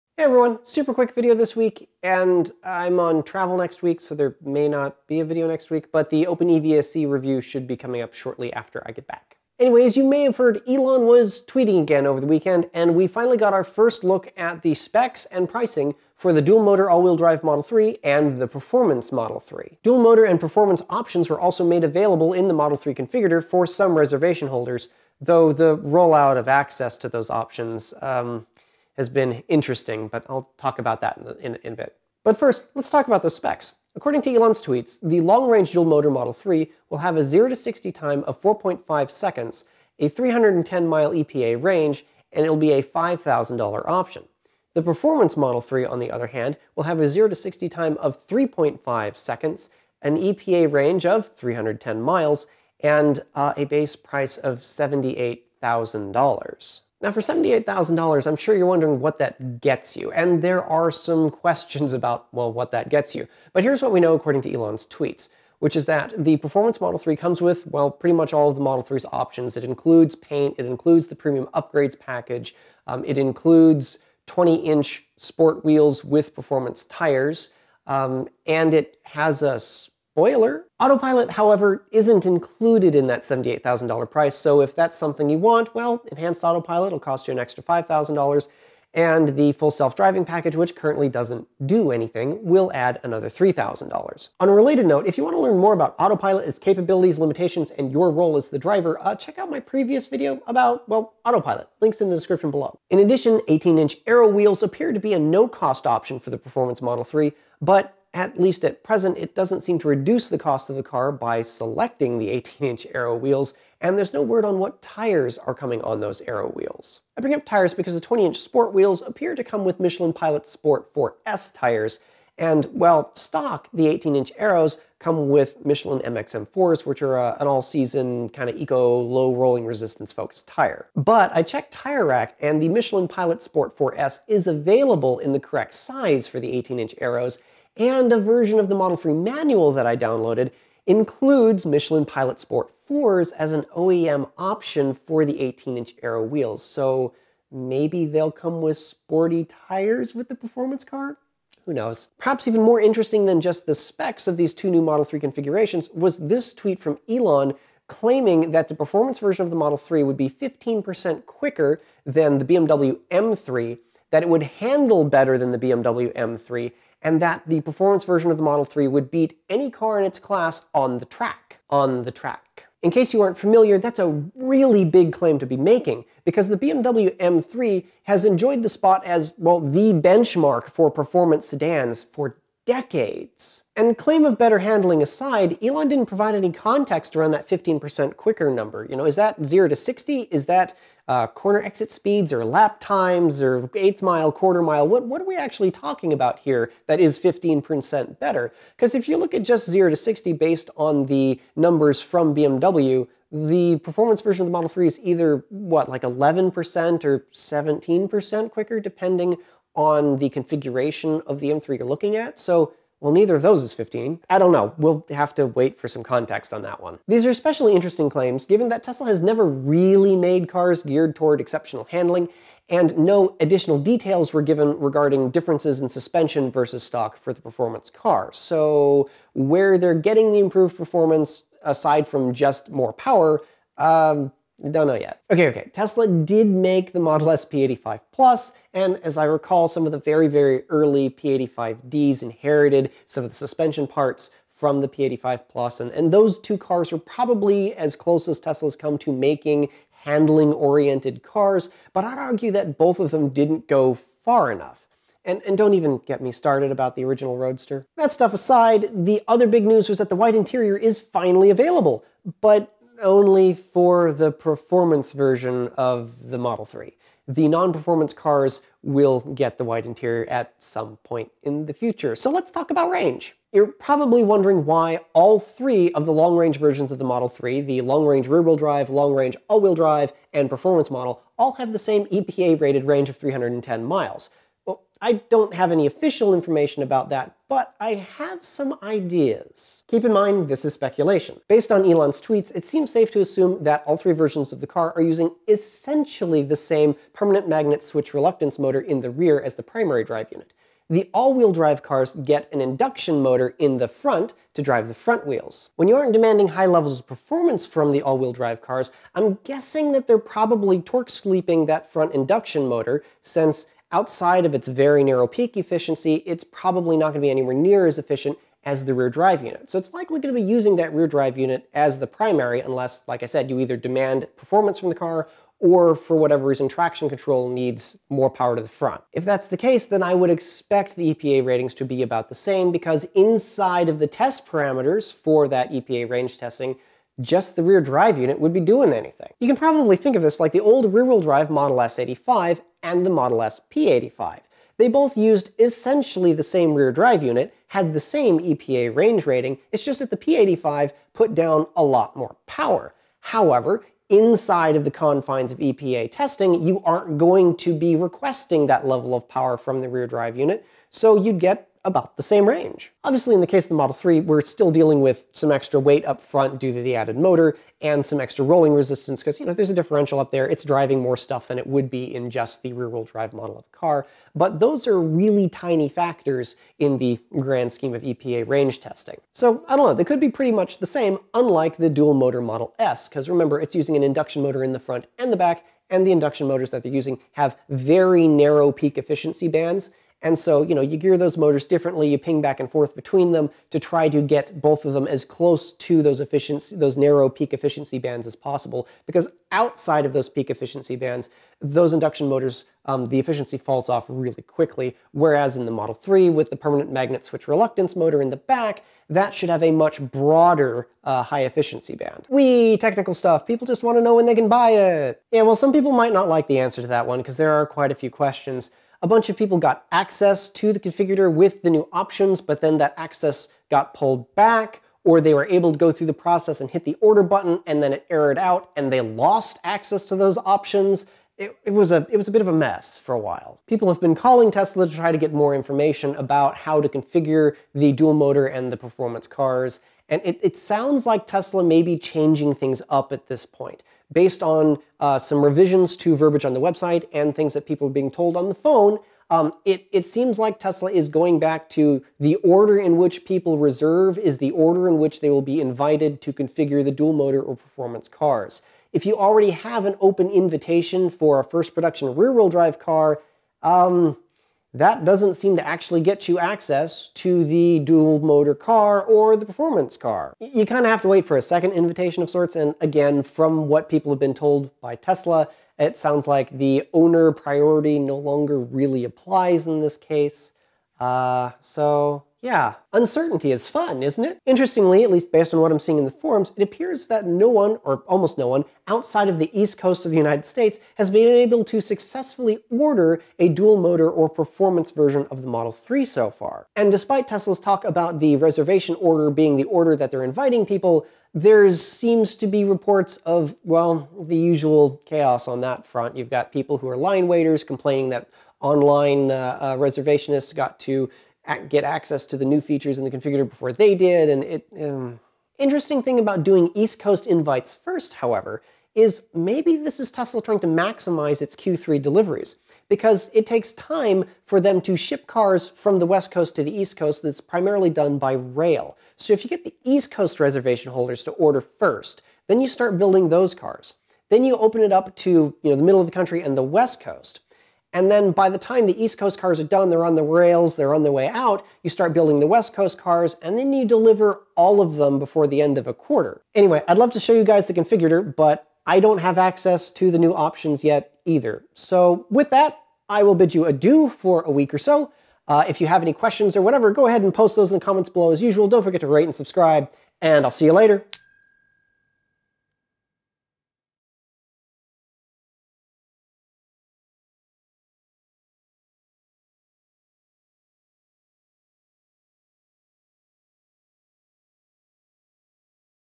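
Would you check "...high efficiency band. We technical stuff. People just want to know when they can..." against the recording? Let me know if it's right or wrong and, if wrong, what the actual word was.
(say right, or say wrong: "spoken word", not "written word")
right.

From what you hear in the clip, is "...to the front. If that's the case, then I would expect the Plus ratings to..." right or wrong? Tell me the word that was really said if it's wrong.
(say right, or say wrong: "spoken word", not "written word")
wrong: "EPA", not "Plus".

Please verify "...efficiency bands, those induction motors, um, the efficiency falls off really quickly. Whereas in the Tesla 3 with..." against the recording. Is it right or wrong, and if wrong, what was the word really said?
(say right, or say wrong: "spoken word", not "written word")
wrong: "Model", not "Tesla".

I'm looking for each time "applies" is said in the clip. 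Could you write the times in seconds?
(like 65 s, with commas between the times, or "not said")
479 s.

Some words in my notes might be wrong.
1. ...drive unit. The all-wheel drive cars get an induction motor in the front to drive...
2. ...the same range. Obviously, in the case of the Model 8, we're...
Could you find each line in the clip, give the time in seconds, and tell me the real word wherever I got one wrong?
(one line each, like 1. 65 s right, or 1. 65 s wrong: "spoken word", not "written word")
1. 300 s right
2. 362 s wrong: "3", not "8".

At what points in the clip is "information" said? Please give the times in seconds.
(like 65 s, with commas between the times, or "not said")
286 s, 435 s.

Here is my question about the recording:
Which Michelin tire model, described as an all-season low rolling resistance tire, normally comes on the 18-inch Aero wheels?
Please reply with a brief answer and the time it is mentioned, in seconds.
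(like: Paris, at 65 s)
Michelin MXM4, at 125 s.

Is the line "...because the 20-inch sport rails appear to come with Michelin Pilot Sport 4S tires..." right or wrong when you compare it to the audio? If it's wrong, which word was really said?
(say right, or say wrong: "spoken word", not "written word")
wrong: "wheels", not "rails".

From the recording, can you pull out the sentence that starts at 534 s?
Then you open it up to you know, the middle of the country and the West Coast.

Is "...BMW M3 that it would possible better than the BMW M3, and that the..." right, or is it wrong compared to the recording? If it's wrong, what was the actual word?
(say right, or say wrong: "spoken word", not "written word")
wrong: "handle", not "possible".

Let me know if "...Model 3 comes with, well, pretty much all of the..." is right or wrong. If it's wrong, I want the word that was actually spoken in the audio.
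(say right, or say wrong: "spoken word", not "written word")
right.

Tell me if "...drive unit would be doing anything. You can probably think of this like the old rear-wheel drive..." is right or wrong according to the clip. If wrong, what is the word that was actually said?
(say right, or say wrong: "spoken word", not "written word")
right.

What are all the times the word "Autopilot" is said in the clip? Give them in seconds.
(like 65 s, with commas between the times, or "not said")
80 s, 86 s, 95 s, 101 s.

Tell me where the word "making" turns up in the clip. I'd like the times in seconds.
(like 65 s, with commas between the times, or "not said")
175 s, 249 s.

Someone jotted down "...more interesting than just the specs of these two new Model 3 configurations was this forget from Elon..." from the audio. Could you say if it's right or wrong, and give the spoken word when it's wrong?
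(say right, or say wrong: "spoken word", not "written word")
wrong: "tweet", not "forget".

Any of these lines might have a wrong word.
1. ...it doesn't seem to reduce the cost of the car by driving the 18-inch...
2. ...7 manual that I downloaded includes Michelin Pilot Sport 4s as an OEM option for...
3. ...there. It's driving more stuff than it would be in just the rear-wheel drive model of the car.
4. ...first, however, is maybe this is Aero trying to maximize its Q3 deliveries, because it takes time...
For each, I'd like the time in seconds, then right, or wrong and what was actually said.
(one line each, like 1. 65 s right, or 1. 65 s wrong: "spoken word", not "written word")
1. 109 s wrong: "selecting", not "driving"
2. 138 s wrong: "3", not "7"
3. 370 s right
4. 517 s wrong: "Tesla", not "Aero".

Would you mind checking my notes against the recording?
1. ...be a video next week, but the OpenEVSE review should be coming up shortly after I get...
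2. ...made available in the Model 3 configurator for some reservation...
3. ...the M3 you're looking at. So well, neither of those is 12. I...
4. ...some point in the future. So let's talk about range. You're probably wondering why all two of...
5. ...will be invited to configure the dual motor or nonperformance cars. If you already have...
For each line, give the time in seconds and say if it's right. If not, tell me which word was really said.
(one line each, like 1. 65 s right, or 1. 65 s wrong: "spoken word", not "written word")
1. 5 s right
2. 21 s right
3. 211 s wrong: "15", not "12"
4. 270 s wrong: "three", not "two"
5. 455 s wrong: "performance", not "nonperformance".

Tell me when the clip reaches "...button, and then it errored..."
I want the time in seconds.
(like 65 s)
427 s.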